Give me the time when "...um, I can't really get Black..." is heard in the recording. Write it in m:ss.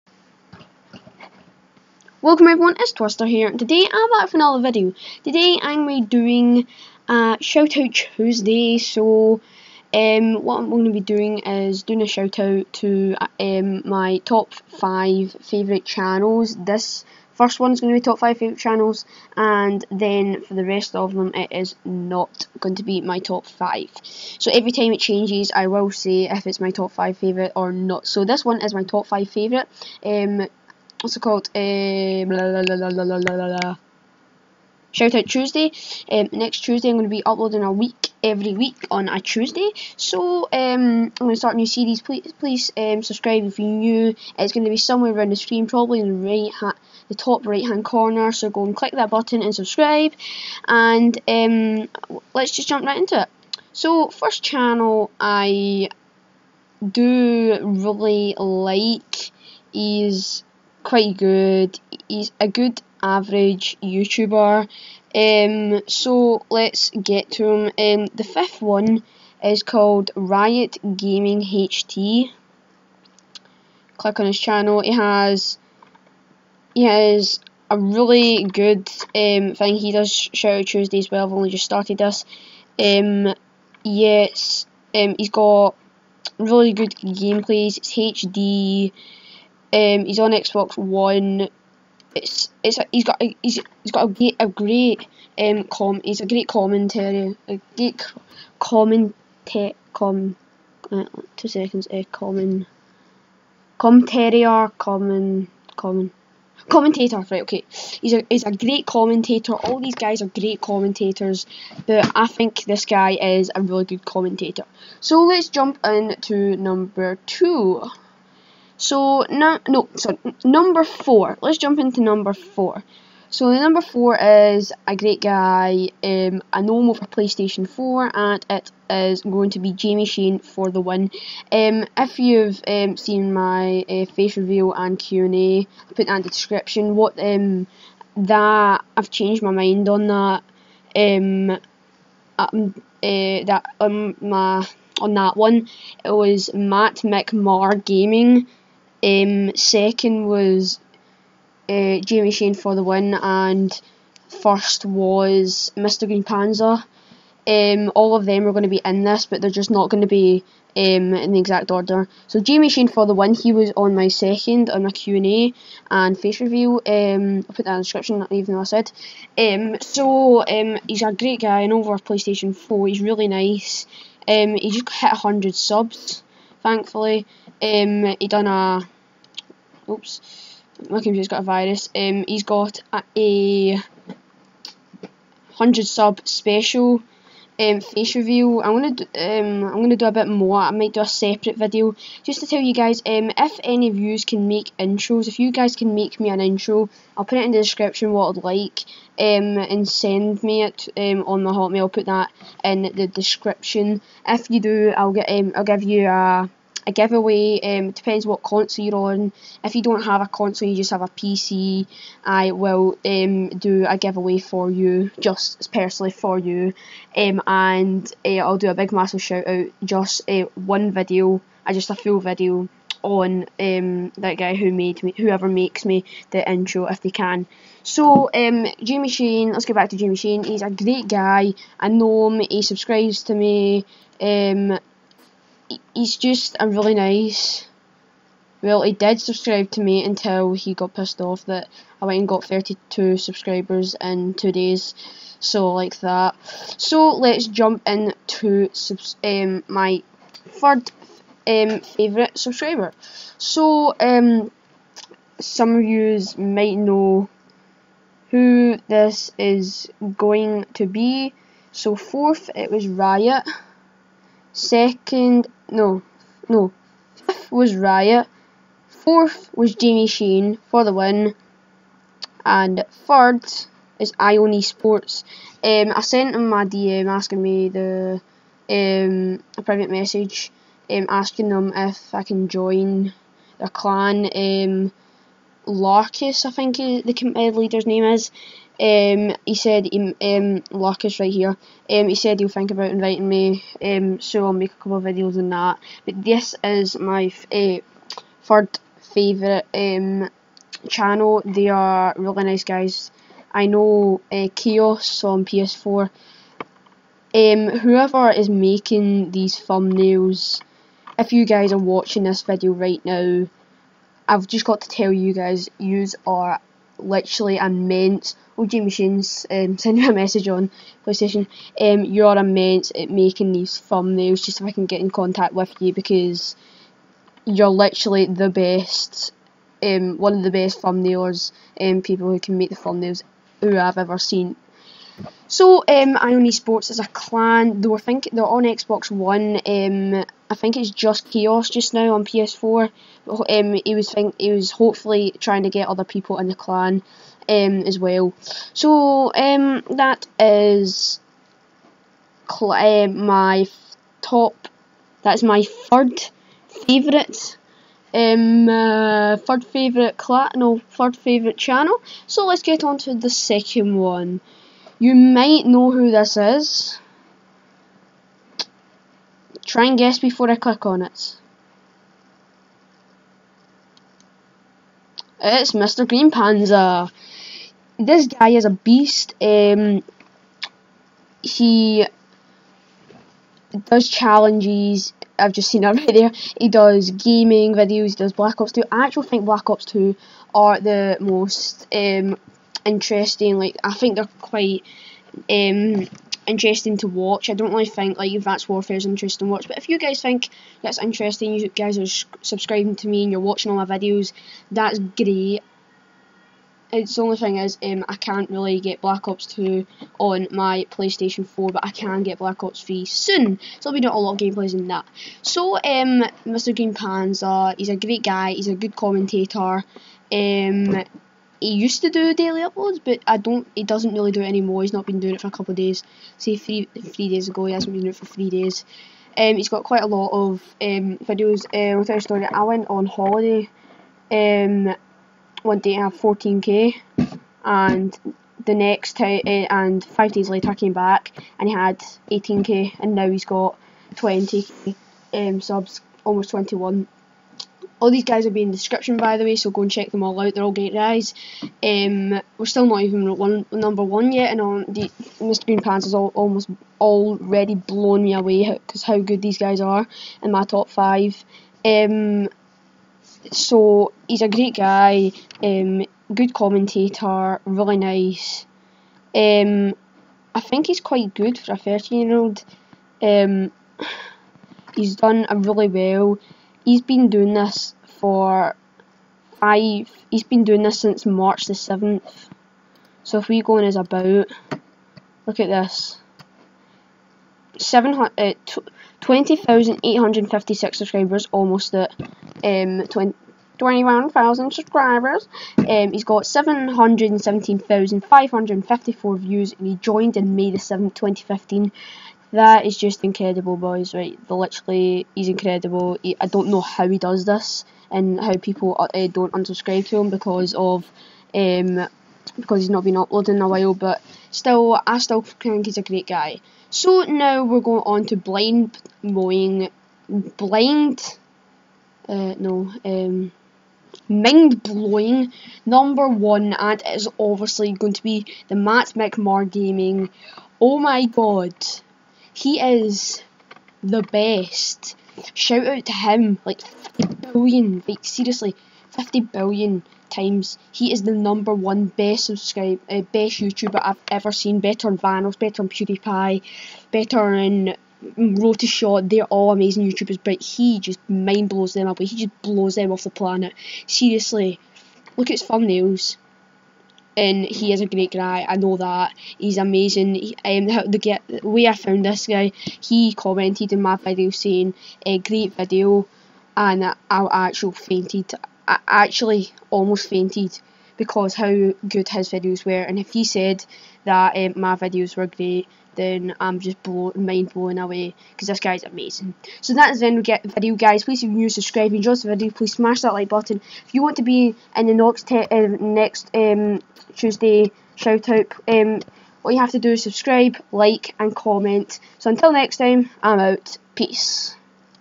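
6:47.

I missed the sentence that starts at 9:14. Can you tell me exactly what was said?
Seriously, look at his thumbnails and he is a great guy.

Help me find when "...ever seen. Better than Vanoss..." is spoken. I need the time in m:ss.
9:04.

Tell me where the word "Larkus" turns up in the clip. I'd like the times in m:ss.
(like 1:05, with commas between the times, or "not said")
4:45, 4:50.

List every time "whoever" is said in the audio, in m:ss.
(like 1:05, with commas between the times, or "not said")
3:45, 5:07.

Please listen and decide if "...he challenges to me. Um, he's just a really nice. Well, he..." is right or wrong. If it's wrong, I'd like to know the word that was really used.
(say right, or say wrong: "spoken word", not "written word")
wrong: "subscribes", not "challenges".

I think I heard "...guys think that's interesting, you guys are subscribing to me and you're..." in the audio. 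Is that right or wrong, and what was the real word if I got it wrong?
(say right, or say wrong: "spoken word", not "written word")
right.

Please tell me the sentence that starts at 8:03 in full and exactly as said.
So if we go on his about, look at this.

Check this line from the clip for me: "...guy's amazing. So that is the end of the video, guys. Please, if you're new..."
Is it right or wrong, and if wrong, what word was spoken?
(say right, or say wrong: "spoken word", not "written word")
right.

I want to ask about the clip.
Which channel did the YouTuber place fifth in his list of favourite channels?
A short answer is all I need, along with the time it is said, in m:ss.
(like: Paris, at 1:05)
Riot Gaming HD, at 1:10.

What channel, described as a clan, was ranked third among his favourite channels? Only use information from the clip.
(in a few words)
Ion eSports.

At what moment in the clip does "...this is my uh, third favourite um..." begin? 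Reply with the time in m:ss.
4:56.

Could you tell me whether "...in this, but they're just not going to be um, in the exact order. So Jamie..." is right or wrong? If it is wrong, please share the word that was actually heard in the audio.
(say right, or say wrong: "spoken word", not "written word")
right.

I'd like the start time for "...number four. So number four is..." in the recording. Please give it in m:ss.
2:02.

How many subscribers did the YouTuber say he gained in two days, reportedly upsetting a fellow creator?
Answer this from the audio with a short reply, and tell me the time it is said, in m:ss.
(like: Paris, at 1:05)
32, at 4:02.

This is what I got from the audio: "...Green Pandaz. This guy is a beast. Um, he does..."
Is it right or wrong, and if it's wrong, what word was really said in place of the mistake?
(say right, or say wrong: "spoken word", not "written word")
right.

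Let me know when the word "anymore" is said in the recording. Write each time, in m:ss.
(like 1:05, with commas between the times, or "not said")
7:04.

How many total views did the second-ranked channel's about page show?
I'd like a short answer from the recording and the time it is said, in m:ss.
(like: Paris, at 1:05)
717,554, at 8:16.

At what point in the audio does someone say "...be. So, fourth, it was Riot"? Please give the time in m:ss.
4:20.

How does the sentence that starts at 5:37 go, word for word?
Though I think they're on Xbox One.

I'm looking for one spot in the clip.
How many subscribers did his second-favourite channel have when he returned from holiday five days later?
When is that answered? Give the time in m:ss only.
7:22.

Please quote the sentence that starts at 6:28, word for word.
I actually think Black Ops 2 are the most um, interesting.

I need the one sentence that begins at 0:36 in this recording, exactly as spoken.
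Um, next Tuesday, I'm going to be uploading a week every week on a Tuesday.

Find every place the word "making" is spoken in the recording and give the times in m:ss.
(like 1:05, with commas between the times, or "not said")
5:08, 5:23.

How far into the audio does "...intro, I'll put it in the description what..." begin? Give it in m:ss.
3:16.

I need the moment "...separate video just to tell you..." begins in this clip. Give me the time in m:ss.
3:11.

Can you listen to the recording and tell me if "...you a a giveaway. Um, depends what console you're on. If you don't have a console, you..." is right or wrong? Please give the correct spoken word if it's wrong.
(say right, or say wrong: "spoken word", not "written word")
right.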